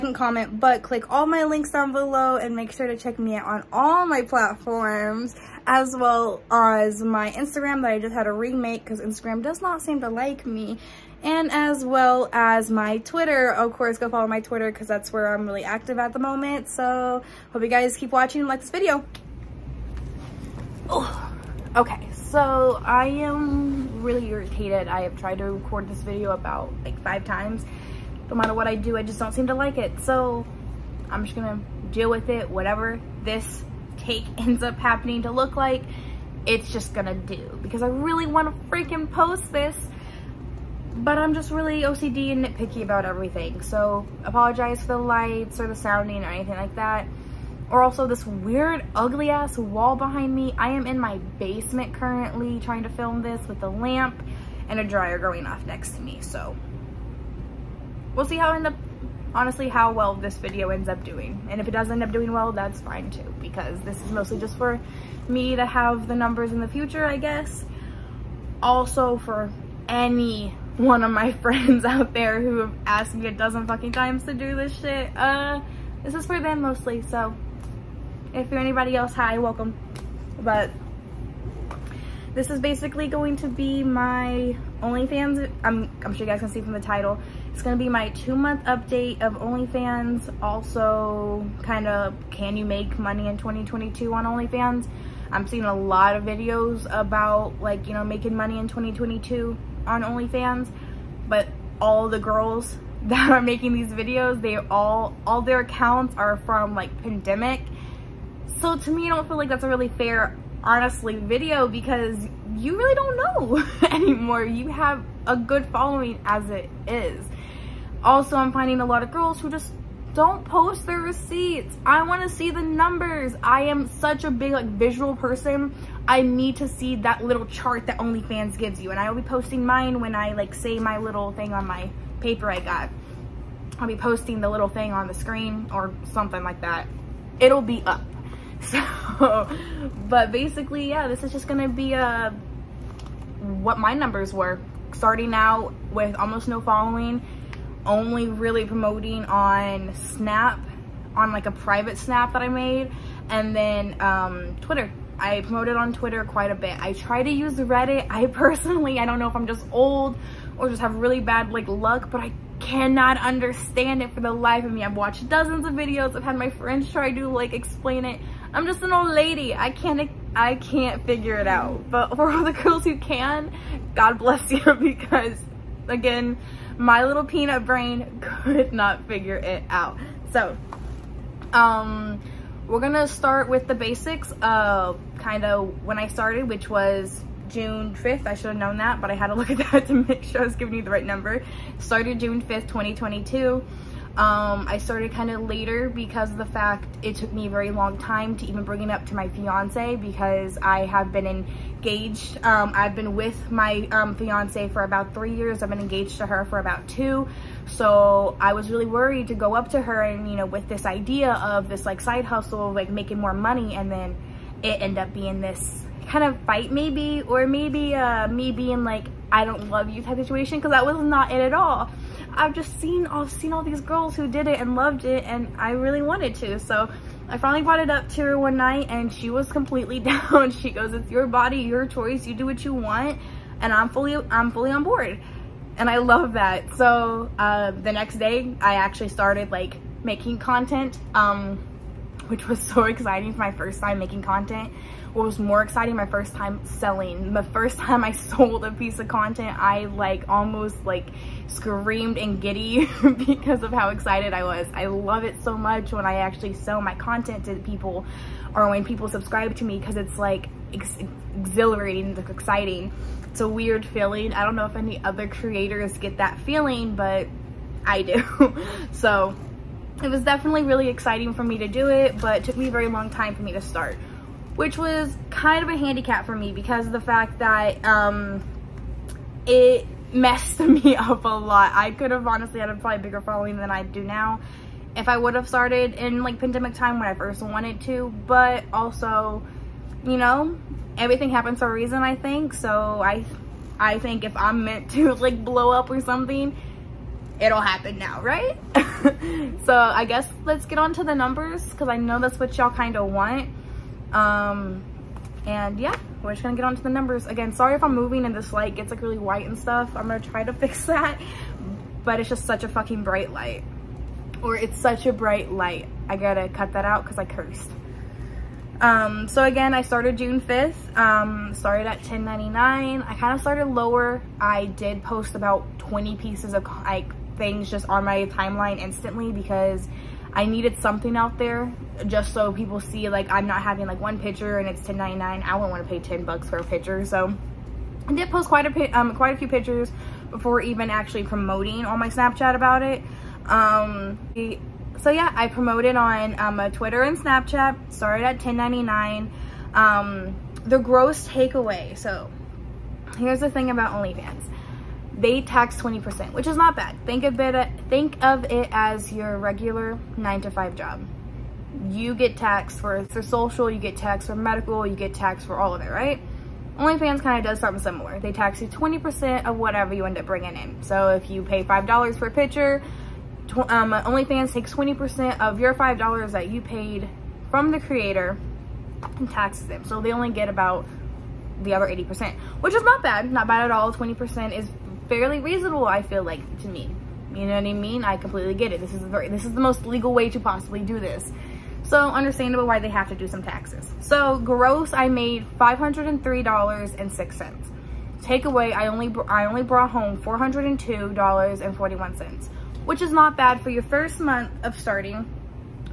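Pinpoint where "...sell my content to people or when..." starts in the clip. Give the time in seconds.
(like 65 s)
256 s.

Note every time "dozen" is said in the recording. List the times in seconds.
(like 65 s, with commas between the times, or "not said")
73 s, 165 s.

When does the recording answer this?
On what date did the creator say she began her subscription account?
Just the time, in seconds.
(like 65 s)
192 s.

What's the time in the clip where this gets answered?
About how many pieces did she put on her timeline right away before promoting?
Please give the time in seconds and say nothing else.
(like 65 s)
325 s.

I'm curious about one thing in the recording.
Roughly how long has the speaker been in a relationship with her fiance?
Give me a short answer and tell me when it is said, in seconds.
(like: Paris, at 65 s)
about three years, at 204 s.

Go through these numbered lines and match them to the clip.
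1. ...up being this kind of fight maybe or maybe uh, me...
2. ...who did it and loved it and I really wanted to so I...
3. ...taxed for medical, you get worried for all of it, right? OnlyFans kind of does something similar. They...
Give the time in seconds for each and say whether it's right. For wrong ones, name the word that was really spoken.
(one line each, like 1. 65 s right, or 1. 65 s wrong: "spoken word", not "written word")
1. 214 s right
2. 224 s right
3. 363 s wrong: "taxed", not "worried".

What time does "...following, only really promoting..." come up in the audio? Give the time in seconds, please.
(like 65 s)
146 s.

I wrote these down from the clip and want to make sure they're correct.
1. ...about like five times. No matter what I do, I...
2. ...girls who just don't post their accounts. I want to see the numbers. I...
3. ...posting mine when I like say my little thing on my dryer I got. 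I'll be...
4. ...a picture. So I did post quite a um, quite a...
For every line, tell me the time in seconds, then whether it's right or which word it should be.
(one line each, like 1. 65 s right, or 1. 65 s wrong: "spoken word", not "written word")
1. 26 s right
2. 119 s wrong: "receipts", not "accounts"
3. 129 s wrong: "paper", not "dryer"
4. 336 s right.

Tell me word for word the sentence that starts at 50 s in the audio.
I am in my basement currently trying to film this with a lamp and a dryer going off next to me.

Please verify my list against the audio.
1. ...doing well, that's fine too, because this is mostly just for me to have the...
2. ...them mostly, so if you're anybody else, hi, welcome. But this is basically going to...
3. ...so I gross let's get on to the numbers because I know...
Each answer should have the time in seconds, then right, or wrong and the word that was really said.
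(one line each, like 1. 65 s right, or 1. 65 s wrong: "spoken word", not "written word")
1. 62 s right
2. 76 s right
3. 299 s wrong: "guess", not "gross".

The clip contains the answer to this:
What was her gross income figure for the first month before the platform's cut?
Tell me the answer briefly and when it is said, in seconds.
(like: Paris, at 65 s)
$503.06, at 395 s.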